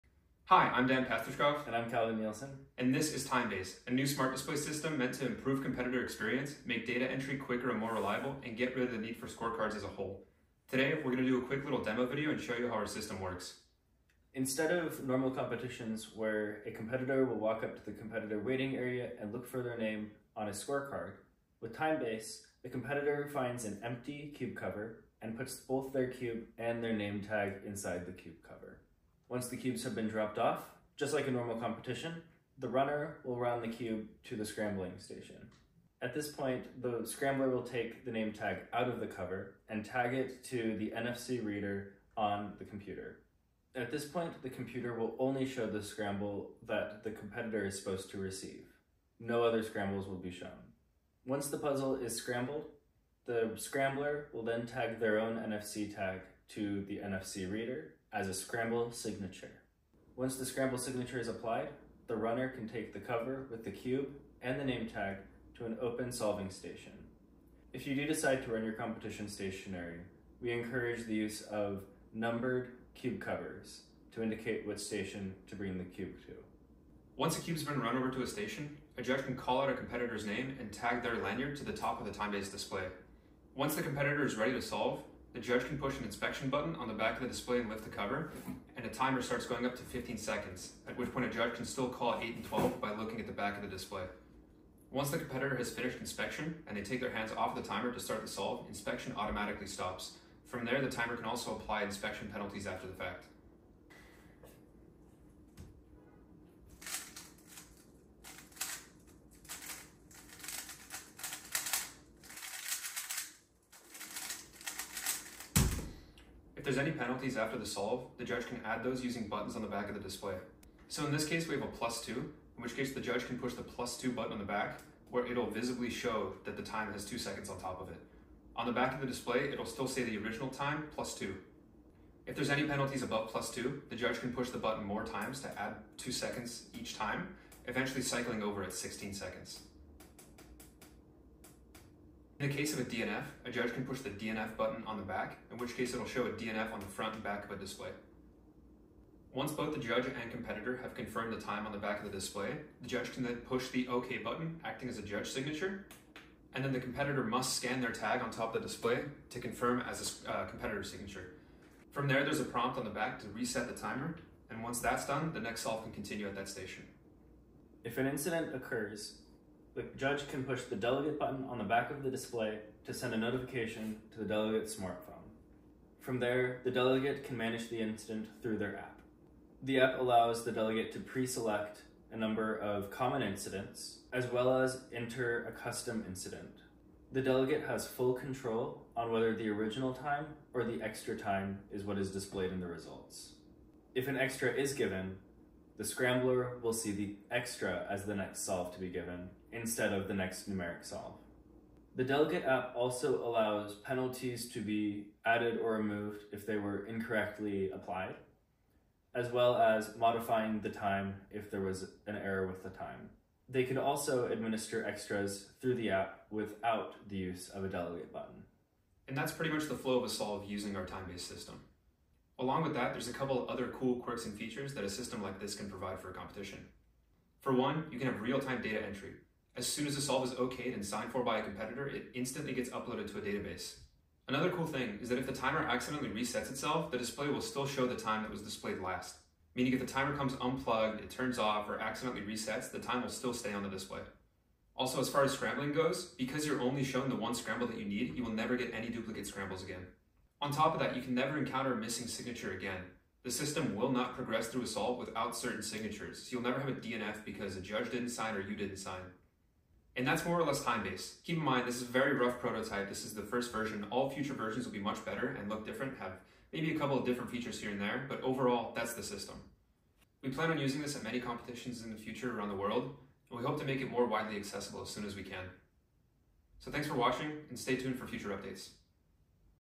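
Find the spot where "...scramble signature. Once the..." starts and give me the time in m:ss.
0:58.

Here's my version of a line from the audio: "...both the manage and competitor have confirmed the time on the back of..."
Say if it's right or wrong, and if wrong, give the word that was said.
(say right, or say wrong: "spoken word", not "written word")
wrong: "judge", not "manage".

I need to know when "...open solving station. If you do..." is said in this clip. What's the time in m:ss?
1:05.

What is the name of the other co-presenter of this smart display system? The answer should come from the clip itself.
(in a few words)
Calvin Nielsen.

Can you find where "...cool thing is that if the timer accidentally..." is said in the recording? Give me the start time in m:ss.
3:54.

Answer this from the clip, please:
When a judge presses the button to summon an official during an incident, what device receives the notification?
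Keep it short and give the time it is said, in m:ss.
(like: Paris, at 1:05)
smartphone, at 2:54.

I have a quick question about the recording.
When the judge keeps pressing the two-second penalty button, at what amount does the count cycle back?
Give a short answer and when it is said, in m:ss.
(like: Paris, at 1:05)
16 seconds, at 2:18.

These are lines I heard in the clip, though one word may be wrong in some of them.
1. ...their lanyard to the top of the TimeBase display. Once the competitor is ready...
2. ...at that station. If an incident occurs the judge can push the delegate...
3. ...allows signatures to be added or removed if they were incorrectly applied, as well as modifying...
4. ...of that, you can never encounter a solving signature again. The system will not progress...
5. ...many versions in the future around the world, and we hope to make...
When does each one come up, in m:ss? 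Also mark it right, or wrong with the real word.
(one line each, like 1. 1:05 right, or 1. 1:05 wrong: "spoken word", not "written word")
1. 1:21 right
2. 2:46 right
3. 3:23 wrong: "penalties", not "signatures"
4. 4:10 wrong: "missing", not "solving"
5. 4:31 wrong: "competitions", not "versions".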